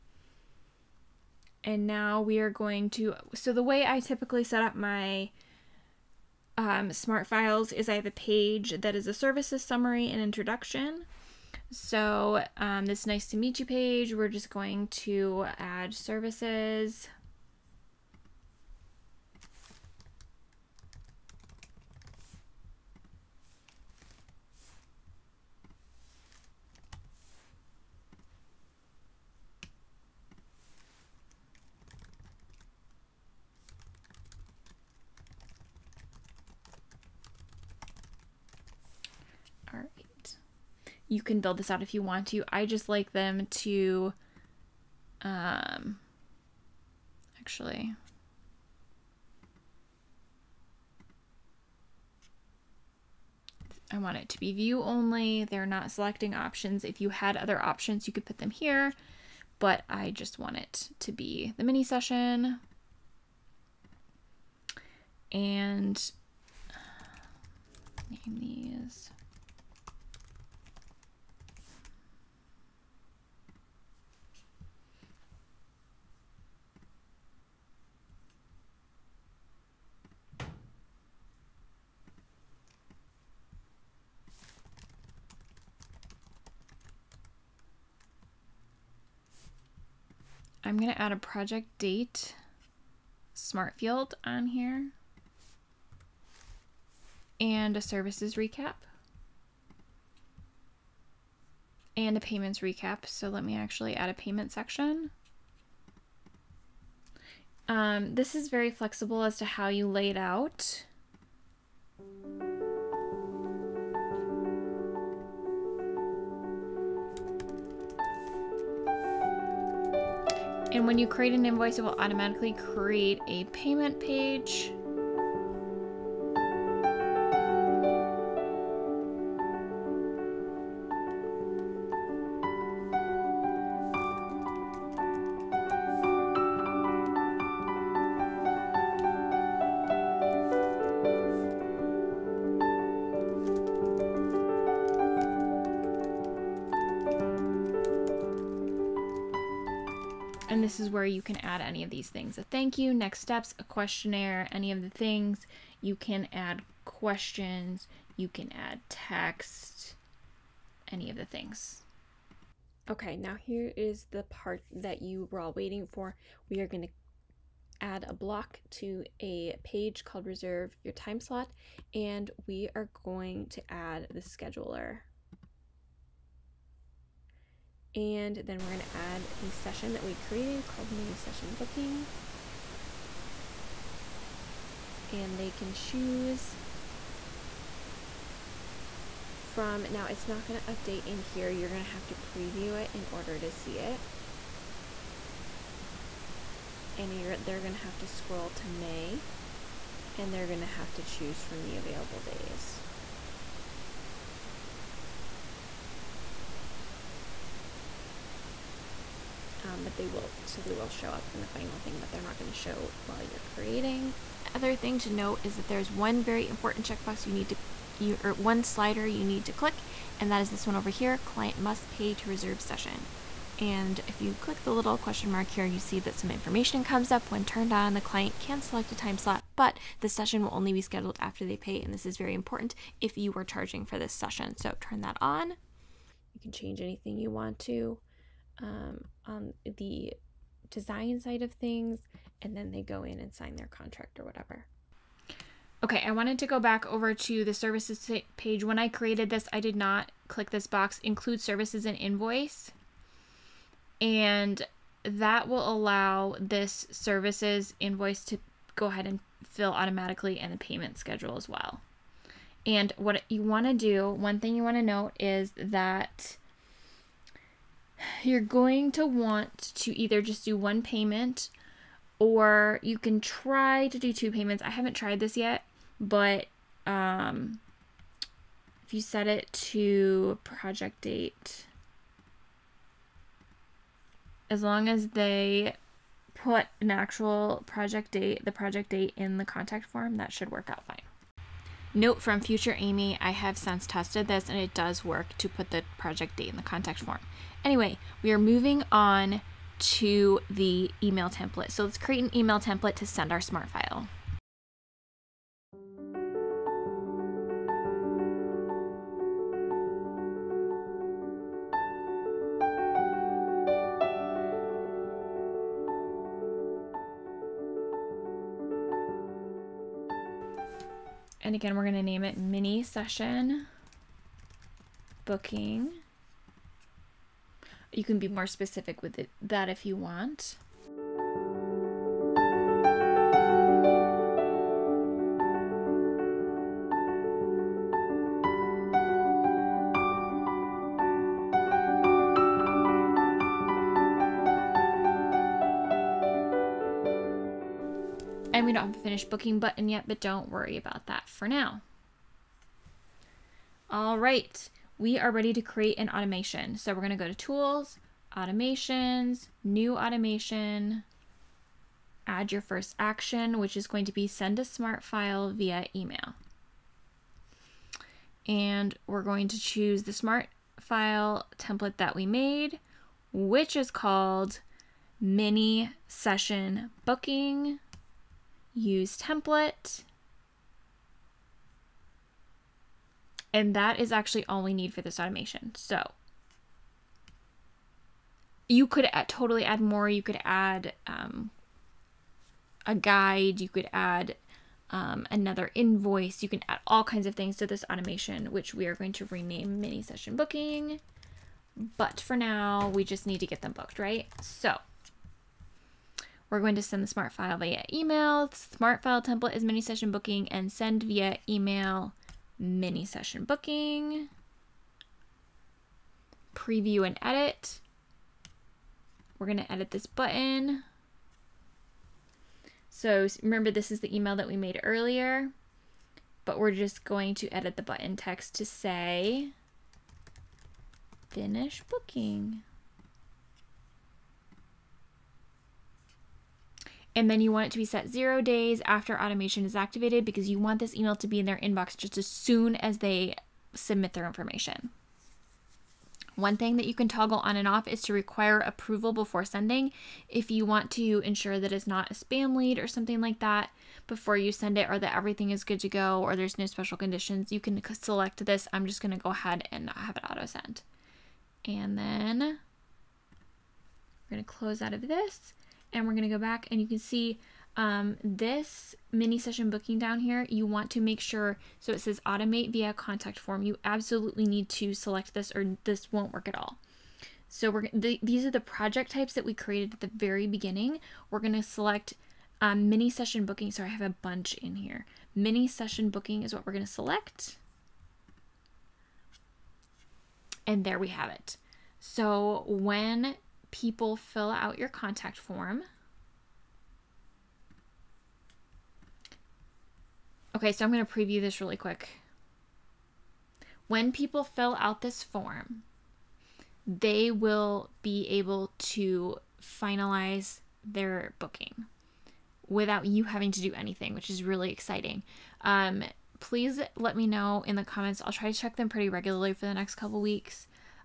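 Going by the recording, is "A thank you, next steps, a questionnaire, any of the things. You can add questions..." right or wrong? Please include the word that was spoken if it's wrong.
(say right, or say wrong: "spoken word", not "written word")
right.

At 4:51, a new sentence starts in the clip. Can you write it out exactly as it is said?
Note from future Amy, I have since tested this and it does work to put the project date in the contact form.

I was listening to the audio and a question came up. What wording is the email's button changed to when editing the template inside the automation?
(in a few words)
Finish booking.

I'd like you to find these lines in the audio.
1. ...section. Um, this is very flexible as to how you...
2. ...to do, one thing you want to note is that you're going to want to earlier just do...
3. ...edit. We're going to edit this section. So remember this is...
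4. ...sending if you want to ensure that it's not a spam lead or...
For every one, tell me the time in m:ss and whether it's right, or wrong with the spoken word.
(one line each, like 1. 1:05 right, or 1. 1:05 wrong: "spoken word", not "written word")
1. 1:44 right
2. 4:23 wrong: "either", not "earlier"
3. 6:57 wrong: "button", not "section"
4. 7:29 right.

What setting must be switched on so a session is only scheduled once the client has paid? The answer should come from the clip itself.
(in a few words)
Client must pay to reserve session.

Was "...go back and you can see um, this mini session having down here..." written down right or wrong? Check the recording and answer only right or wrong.
wrong.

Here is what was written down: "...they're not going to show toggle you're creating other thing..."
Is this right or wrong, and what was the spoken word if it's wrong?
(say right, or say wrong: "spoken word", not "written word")
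wrong: "while", not "toggle".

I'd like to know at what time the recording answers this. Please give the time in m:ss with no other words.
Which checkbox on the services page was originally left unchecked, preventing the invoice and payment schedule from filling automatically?
4:11.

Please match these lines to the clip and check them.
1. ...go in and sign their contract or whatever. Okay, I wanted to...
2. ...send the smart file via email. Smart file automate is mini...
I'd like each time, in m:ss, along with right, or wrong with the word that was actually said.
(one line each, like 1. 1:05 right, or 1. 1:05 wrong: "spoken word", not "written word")
1. 4:02 right
2. 6:46 wrong: "template", not "automate".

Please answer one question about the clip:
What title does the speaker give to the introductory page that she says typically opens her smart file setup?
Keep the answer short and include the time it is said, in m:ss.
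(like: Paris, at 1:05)
Nice to meet you, at 0:13.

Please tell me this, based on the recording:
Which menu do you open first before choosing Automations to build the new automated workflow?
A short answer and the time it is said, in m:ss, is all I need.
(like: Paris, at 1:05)
Tools, at 5:57.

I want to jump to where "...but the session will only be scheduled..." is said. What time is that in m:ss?
3:49.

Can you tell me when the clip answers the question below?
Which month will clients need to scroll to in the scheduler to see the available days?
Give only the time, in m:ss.
3:18.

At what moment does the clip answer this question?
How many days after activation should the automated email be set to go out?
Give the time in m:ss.
7:18.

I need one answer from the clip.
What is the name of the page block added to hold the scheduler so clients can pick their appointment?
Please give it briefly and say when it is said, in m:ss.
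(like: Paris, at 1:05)
Reserve your time slot, at 2:50.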